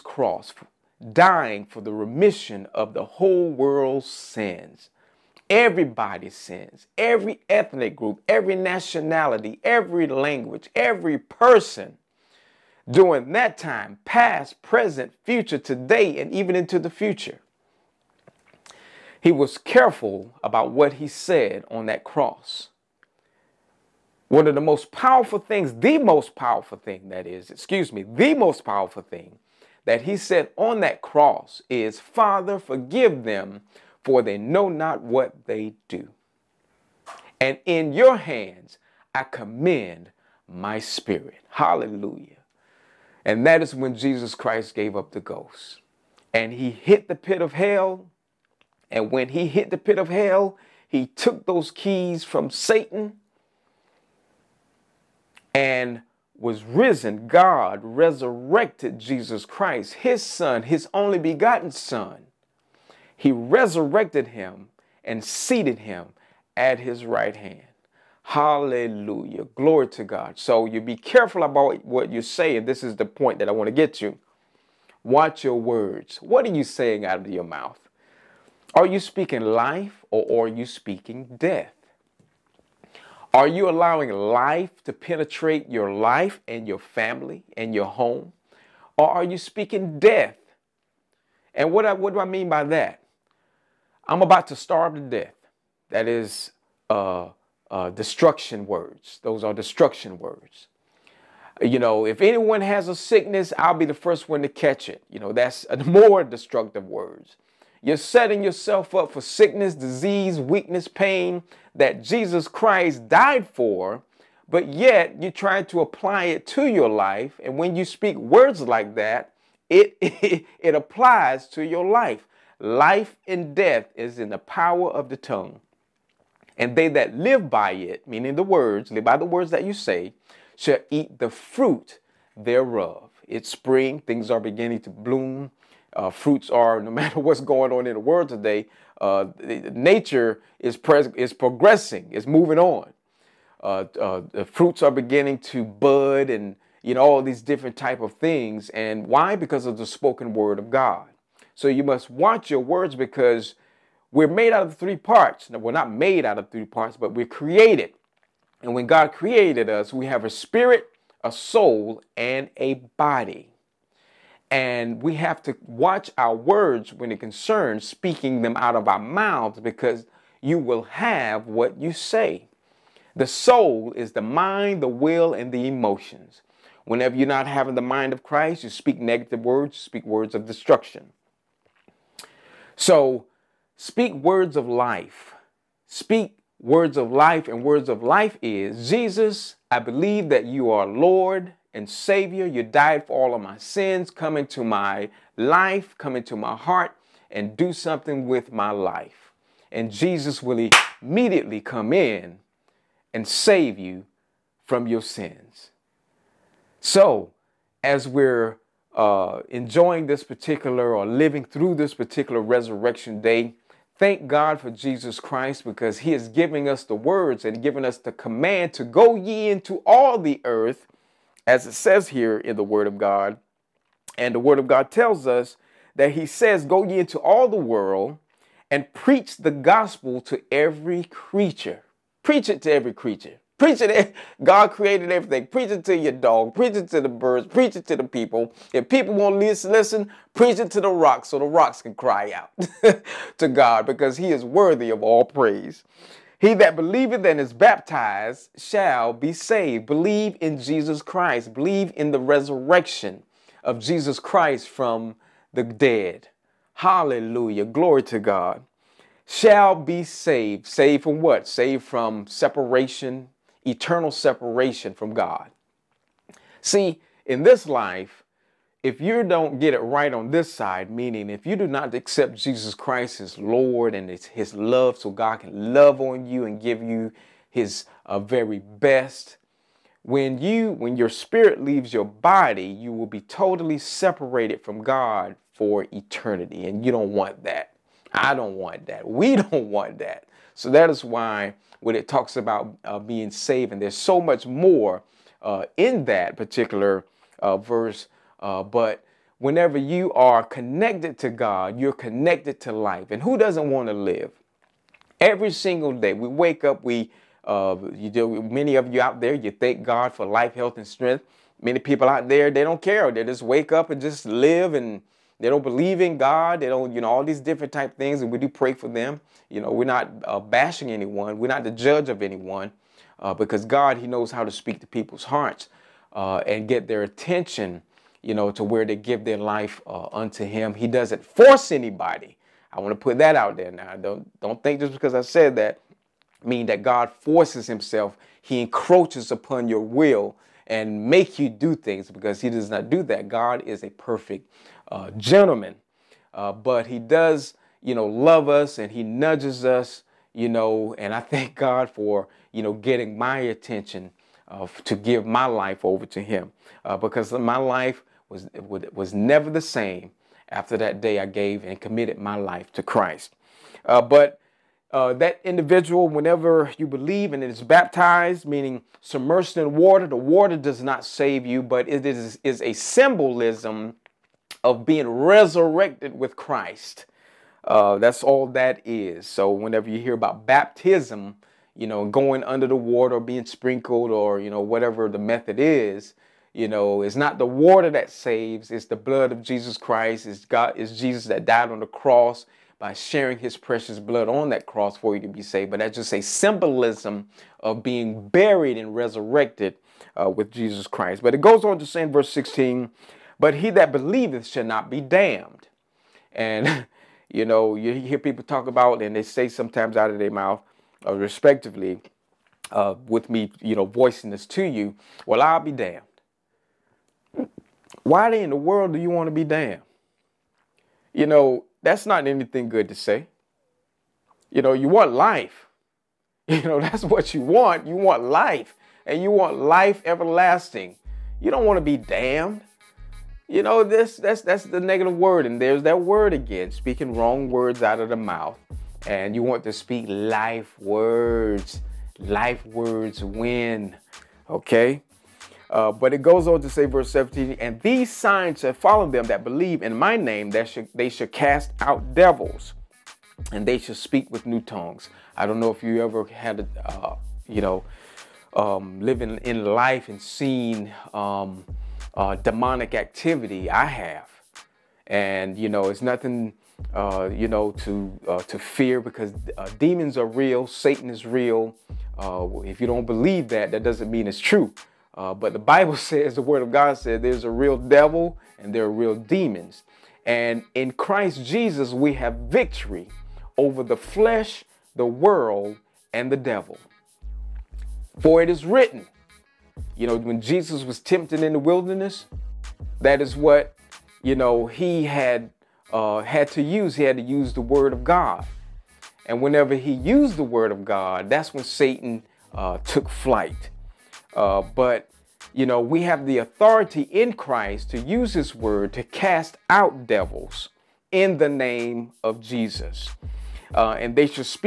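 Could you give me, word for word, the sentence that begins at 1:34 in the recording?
I'm about to starve to death.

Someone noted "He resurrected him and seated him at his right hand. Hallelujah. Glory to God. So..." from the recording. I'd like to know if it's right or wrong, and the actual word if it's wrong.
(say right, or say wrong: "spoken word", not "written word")
right.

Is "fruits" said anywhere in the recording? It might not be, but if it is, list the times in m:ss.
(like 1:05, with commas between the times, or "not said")
2:11, 2:16, 2:24.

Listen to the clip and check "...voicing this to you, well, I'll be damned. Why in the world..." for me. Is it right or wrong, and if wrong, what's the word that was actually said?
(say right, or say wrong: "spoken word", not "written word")
right.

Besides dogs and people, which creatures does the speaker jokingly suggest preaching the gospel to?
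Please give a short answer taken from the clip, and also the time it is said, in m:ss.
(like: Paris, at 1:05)
The birds, at 3:57.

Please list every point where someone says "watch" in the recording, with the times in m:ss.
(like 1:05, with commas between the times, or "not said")
1:15, 2:32, 2:45.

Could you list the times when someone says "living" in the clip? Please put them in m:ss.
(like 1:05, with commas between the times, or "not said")
3:31, 7:39.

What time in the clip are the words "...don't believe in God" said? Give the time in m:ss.
5:15.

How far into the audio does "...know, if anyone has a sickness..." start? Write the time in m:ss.
1:41.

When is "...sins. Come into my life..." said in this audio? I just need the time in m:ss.
3:13.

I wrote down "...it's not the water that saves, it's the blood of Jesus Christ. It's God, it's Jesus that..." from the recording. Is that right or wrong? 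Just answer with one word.
right.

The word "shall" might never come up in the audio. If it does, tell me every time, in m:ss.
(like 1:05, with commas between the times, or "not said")
2:10, 4:08, 4:19, 6:44, 7:28.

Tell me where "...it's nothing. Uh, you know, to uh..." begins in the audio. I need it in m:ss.
7:45.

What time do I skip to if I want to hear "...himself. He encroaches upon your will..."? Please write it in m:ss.
5:37.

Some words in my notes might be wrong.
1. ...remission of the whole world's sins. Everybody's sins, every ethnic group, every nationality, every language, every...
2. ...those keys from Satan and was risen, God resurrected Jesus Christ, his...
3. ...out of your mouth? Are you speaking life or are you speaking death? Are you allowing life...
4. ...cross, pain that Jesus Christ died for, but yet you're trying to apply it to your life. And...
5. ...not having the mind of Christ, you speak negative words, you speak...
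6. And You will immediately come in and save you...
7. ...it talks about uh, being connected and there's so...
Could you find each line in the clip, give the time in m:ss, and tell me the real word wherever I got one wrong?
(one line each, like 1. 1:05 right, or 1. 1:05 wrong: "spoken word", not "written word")
1. 0:01 right
2. 0:51 right
3. 1:17 right
4. 1:50 wrong: "weakness", not "cross"
5. 2:57 right
6. 3:19 wrong: "Jesus", not "You"
7. 4:51 wrong: "saved", not "connected".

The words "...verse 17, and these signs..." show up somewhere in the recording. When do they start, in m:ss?
7:26.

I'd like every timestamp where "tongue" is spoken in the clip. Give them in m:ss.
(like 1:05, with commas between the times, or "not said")
2:05, 7:34.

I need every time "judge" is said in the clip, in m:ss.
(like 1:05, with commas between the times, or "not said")
5:21.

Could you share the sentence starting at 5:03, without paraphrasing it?
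And who doesn't want to live?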